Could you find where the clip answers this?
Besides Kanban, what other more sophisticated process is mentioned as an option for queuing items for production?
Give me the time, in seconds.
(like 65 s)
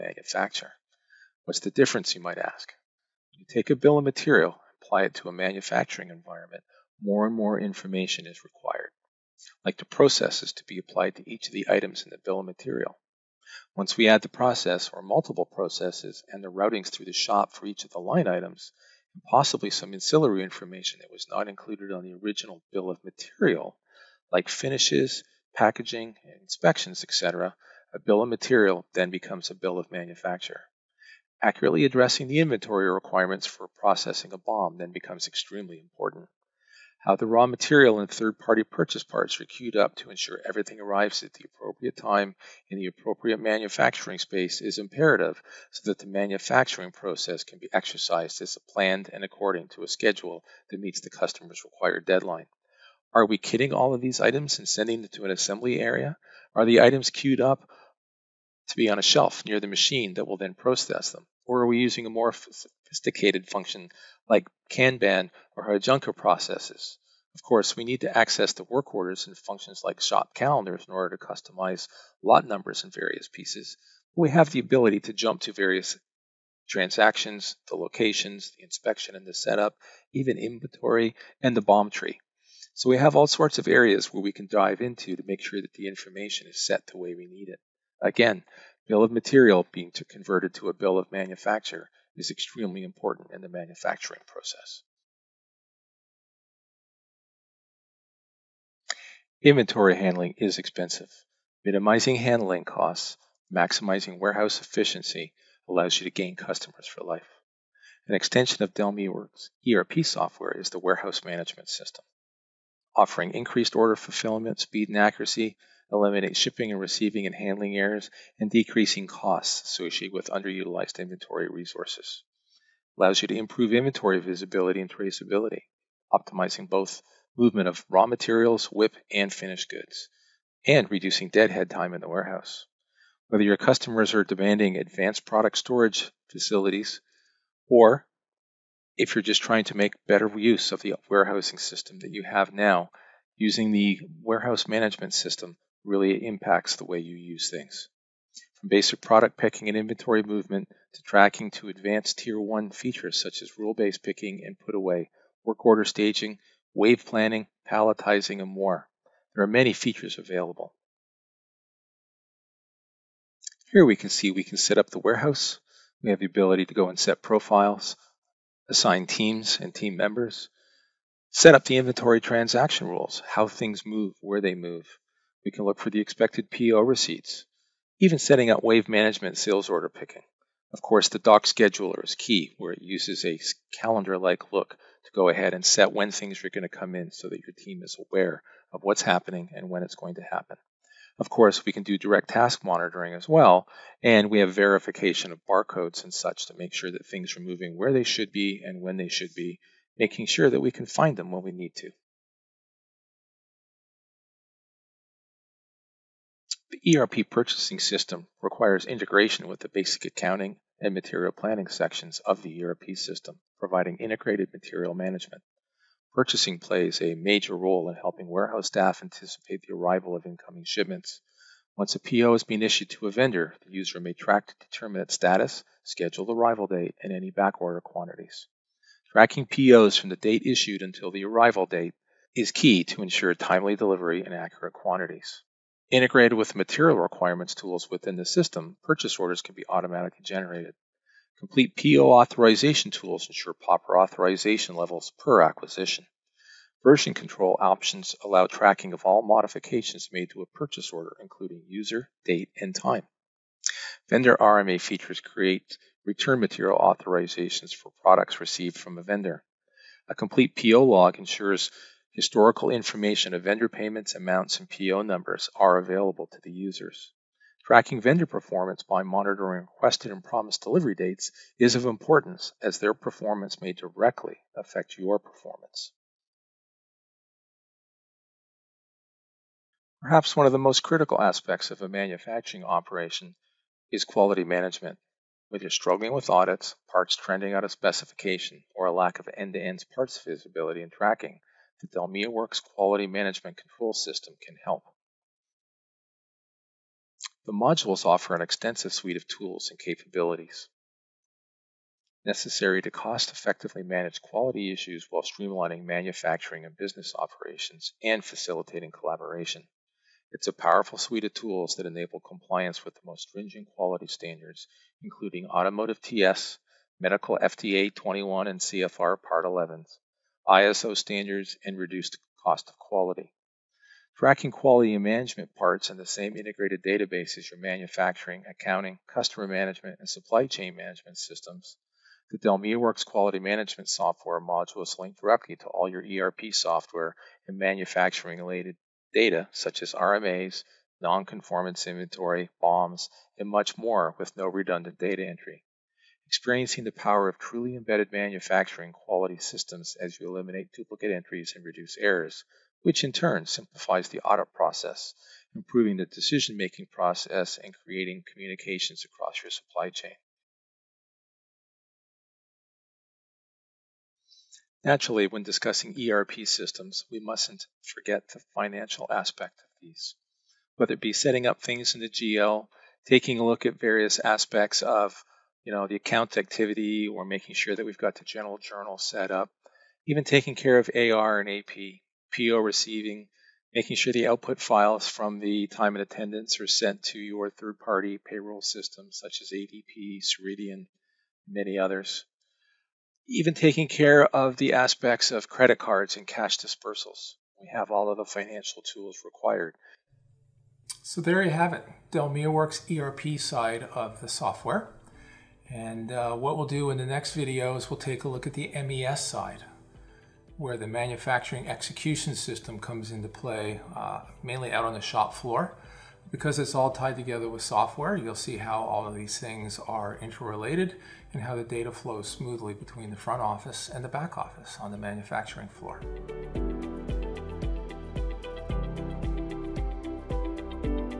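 65 s.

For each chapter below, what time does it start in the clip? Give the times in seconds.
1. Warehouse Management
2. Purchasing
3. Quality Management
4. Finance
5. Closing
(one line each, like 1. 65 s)
1. 95 s
2. 203 s
3. 276 s
4. 361 s
5. 401 s.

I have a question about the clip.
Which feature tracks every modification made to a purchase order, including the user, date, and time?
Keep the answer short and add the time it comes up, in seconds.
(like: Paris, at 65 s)
Version control, at 246 s.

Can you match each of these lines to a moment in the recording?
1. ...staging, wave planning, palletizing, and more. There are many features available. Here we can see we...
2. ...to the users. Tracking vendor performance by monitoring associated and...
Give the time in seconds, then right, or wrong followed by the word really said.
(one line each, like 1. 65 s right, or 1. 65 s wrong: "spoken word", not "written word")
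1. 155 s right
2. 266 s wrong: "requested", not "associated".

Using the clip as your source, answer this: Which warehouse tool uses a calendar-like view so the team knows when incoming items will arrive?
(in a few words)
Dock scheduler.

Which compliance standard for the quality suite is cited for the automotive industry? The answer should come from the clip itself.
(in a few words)
TS.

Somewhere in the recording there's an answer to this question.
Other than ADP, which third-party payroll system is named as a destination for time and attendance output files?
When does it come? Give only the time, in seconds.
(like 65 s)
390 s.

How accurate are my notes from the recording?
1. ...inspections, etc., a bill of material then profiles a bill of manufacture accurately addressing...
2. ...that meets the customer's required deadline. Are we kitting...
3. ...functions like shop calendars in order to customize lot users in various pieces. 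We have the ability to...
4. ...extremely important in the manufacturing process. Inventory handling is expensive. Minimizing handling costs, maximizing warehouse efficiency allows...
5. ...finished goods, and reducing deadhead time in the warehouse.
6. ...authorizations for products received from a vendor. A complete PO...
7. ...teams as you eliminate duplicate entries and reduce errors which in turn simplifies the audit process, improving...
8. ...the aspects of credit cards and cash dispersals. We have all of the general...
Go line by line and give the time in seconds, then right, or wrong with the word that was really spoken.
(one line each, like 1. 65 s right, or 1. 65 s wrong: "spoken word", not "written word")
1. 26 s wrong: "becomes", not "profiles"
2. 50 s right
3. 69 s wrong: "numbers", not "users"
4. 92 s right
5. 129 s right
6. 256 s right
7. 349 s wrong: "systems", not "teams"
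8. 394 s wrong: "financial", not "general".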